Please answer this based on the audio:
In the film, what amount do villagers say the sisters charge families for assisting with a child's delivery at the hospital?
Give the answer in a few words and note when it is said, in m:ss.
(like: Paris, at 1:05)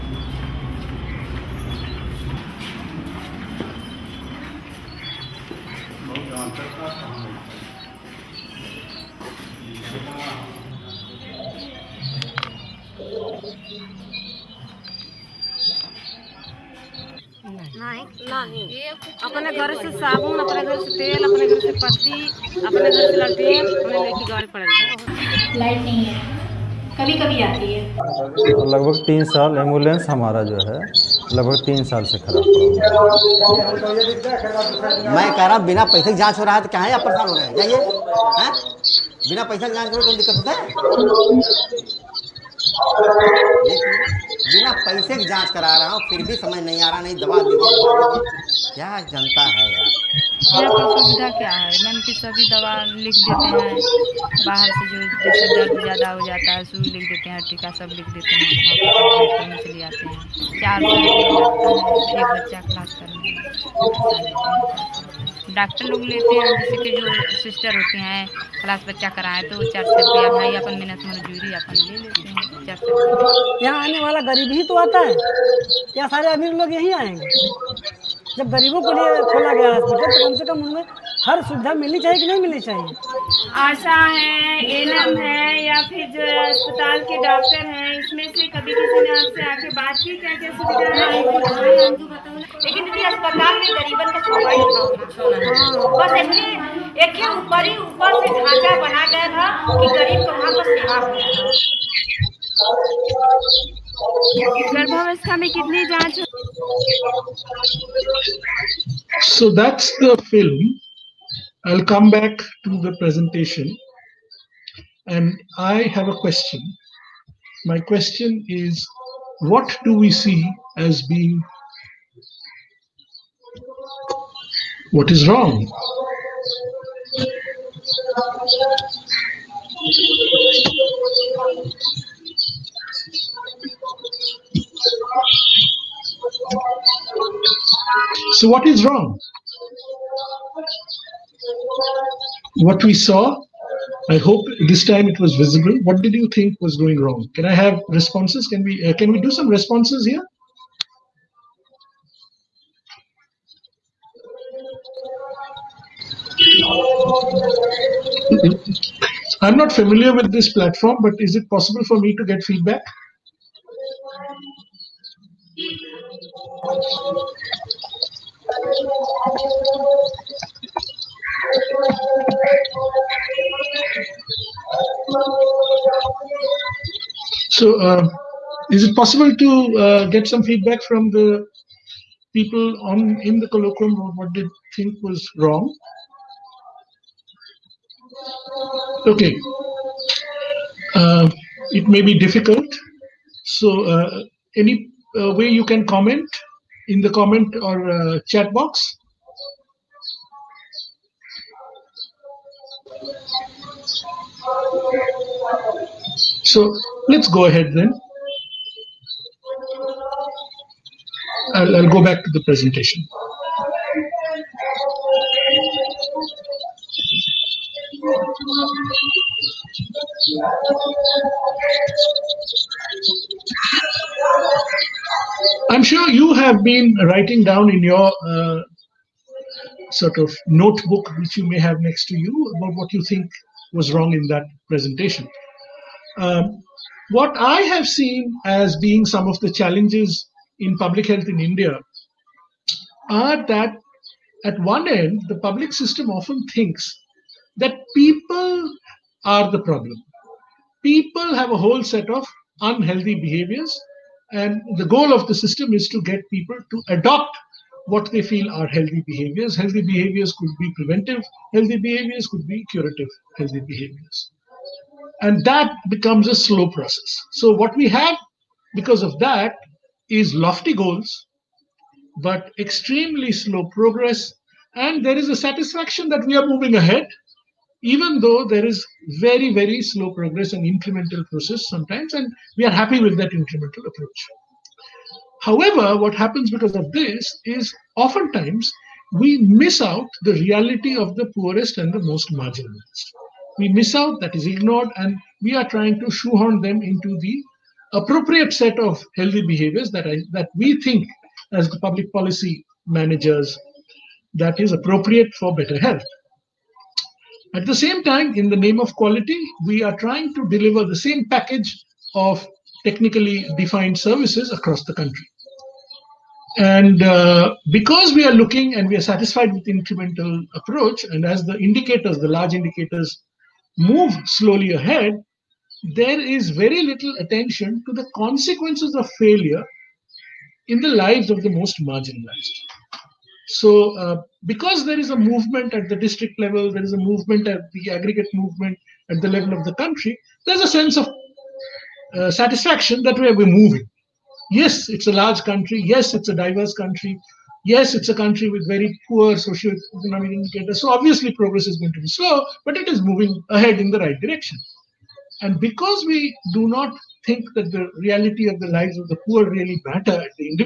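400 rupees, at 1:09.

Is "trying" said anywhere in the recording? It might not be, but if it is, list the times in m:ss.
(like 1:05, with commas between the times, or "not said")
4:55, 5:09.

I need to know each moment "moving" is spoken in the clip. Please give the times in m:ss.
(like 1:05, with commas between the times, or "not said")
4:36, 5:43, 5:53.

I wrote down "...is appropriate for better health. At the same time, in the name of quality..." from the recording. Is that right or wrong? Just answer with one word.
right.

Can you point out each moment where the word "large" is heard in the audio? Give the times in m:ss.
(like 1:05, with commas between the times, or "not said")
5:22, 5:45.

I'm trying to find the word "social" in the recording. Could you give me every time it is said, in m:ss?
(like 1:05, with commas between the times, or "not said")
5:49.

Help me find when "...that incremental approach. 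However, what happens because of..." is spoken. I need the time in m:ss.
4:43.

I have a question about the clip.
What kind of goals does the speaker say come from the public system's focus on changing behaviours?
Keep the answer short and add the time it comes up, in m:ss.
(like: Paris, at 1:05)
lofty goals, at 4:30.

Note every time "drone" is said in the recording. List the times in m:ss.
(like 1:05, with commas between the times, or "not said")
not said.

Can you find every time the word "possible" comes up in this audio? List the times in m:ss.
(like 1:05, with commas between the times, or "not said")
2:41, 2:58.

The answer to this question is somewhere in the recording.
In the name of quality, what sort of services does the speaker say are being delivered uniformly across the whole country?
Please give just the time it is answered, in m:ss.
5:12.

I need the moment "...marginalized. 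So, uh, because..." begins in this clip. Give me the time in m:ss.
5:31.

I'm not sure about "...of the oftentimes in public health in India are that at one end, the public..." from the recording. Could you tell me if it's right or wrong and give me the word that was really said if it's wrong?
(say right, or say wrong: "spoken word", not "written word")
wrong: "challenges", not "oftentimes".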